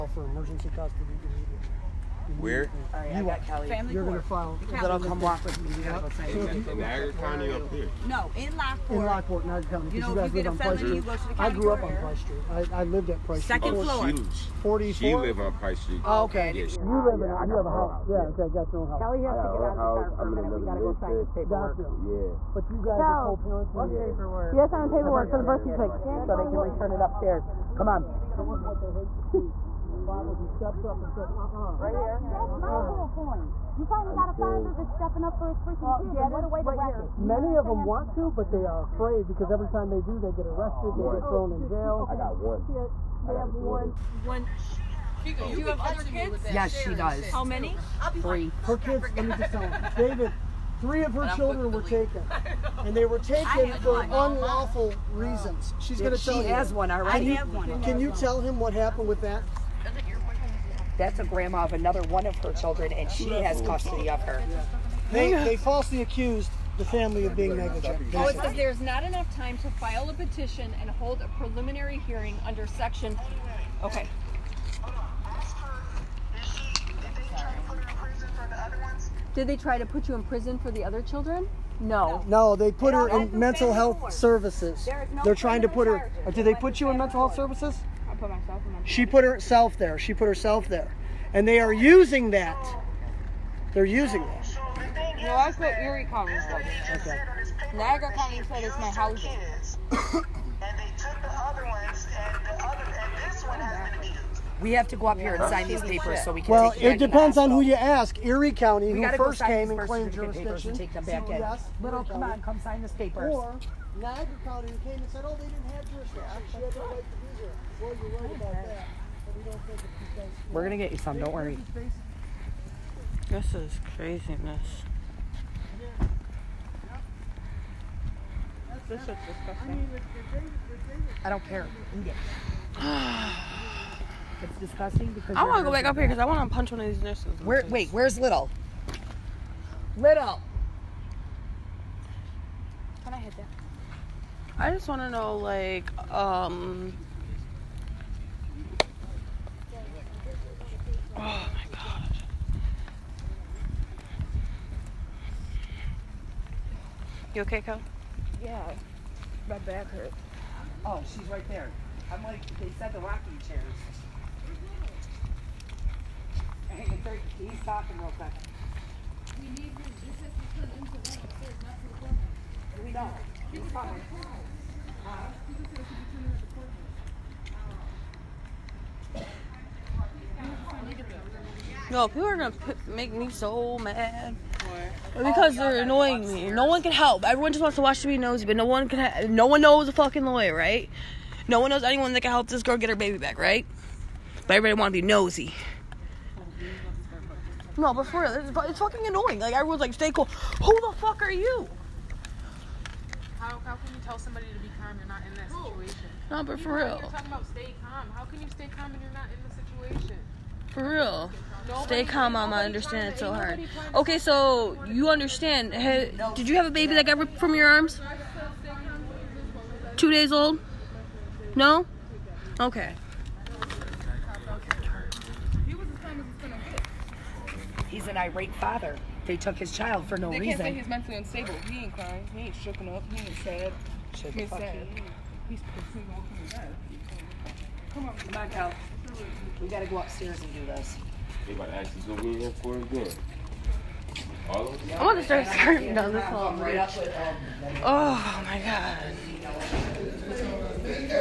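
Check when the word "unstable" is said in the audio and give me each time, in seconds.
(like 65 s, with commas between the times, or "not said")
231 s.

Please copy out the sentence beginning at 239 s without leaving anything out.
We gotta go upstairs and do this.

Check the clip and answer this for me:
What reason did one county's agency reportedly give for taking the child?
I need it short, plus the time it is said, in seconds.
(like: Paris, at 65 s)
Housing, at 98 s.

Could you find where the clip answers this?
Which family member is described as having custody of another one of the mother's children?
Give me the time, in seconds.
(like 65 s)
61 s.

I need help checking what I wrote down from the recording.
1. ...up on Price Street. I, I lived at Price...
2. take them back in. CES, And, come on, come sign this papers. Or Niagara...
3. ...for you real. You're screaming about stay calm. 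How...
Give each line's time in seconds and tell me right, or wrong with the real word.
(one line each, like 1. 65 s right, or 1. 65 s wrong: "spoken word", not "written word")
1. 11 s right
2. 110 s wrong: "Little", not "And"
3. 206 s wrong: "talking", not "screaming".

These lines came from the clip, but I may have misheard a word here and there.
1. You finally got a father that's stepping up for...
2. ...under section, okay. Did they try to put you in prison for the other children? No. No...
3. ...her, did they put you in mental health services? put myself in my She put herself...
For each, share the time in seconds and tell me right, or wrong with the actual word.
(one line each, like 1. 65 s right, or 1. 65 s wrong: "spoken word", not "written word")
1. 33 s right
2. 72 s right
3. 85 s right.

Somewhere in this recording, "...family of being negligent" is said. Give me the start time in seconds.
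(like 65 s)
66 s.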